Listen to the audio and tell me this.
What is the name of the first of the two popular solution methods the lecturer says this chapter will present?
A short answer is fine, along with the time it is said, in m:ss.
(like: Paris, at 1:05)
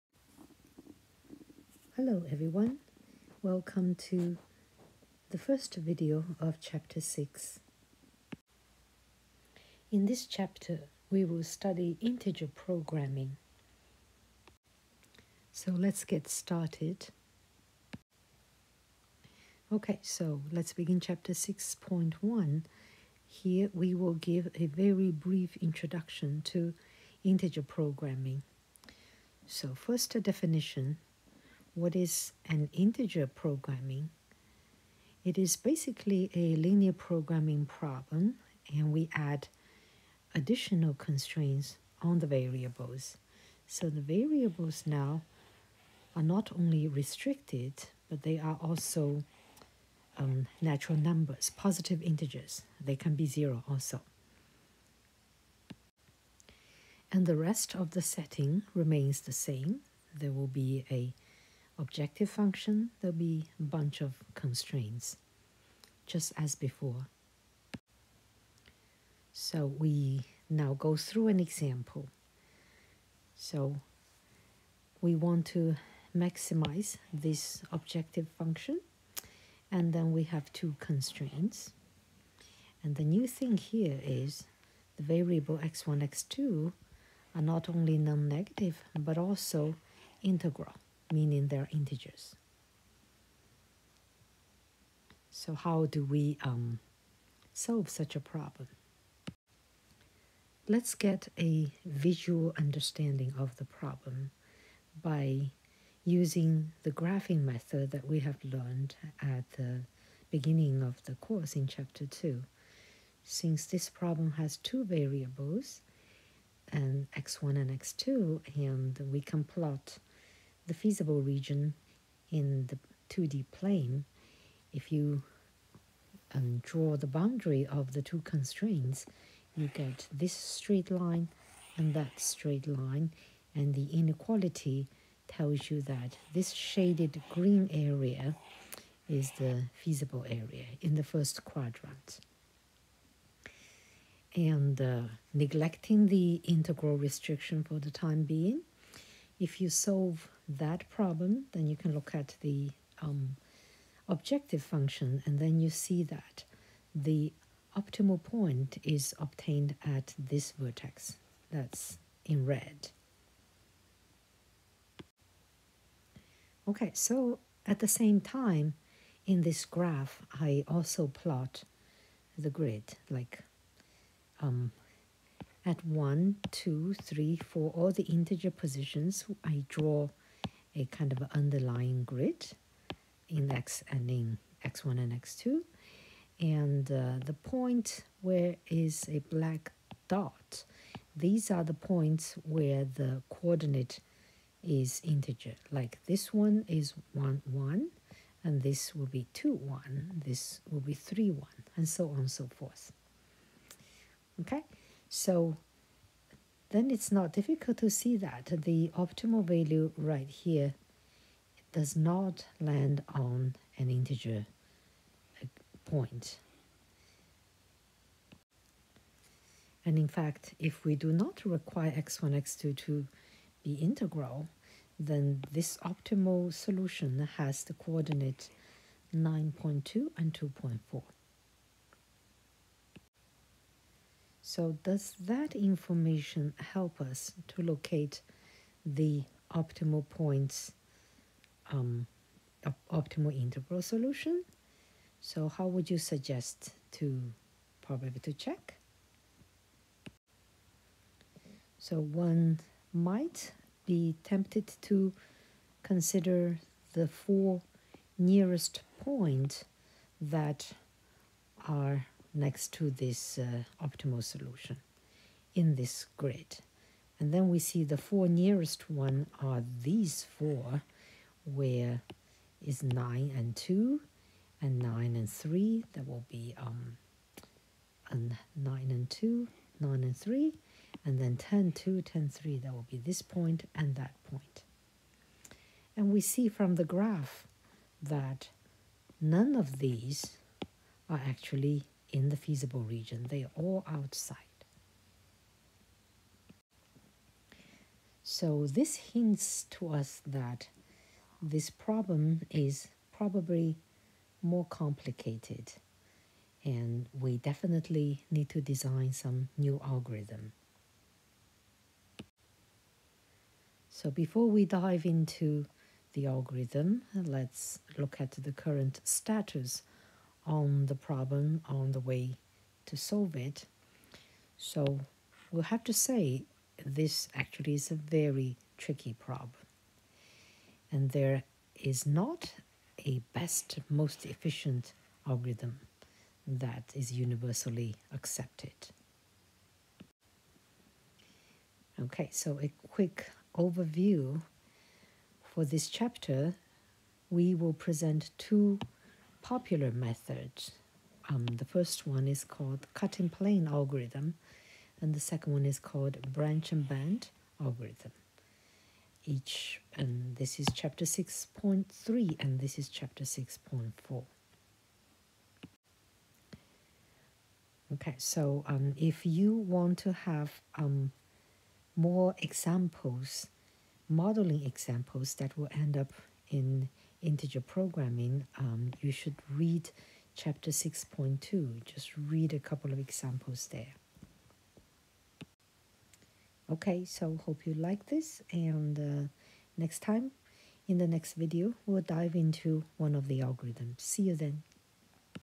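Cutting plane algorithm, at 5:52.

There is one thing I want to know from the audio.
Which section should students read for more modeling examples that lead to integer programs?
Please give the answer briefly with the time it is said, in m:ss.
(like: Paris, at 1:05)
6.2, at 6:20.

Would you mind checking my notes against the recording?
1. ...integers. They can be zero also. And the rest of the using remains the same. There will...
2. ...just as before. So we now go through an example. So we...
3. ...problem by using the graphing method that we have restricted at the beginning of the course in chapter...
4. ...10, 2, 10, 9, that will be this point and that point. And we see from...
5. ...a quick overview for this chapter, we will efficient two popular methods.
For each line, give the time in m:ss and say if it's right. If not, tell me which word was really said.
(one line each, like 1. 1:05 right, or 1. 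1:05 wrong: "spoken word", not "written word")
1. 0:52 wrong: "setting", not "using"
2. 1:06 right
3. 1:43 wrong: "learned", not "restricted"
4. 4:41 wrong: "3", not "9"
5. 5:42 wrong: "present", not "efficient".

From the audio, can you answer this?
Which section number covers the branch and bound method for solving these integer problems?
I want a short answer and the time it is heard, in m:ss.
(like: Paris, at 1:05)
6.4, at 6:02.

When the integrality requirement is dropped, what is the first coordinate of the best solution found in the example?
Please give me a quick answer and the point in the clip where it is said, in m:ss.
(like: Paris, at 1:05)
9.2, at 3:49.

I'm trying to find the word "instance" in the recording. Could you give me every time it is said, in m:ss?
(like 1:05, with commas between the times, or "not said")
not said.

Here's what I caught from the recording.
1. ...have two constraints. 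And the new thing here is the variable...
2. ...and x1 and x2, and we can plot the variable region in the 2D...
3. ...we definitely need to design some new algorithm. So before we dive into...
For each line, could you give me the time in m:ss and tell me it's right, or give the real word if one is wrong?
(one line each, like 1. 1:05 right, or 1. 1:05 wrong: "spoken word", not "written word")
1. 1:20 right
2. 1:56 wrong: "feasible", not "variable"
3. 5:07 right.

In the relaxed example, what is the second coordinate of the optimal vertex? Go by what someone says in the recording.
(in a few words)
2.4.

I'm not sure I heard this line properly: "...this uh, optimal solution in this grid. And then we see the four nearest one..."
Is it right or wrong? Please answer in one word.
right.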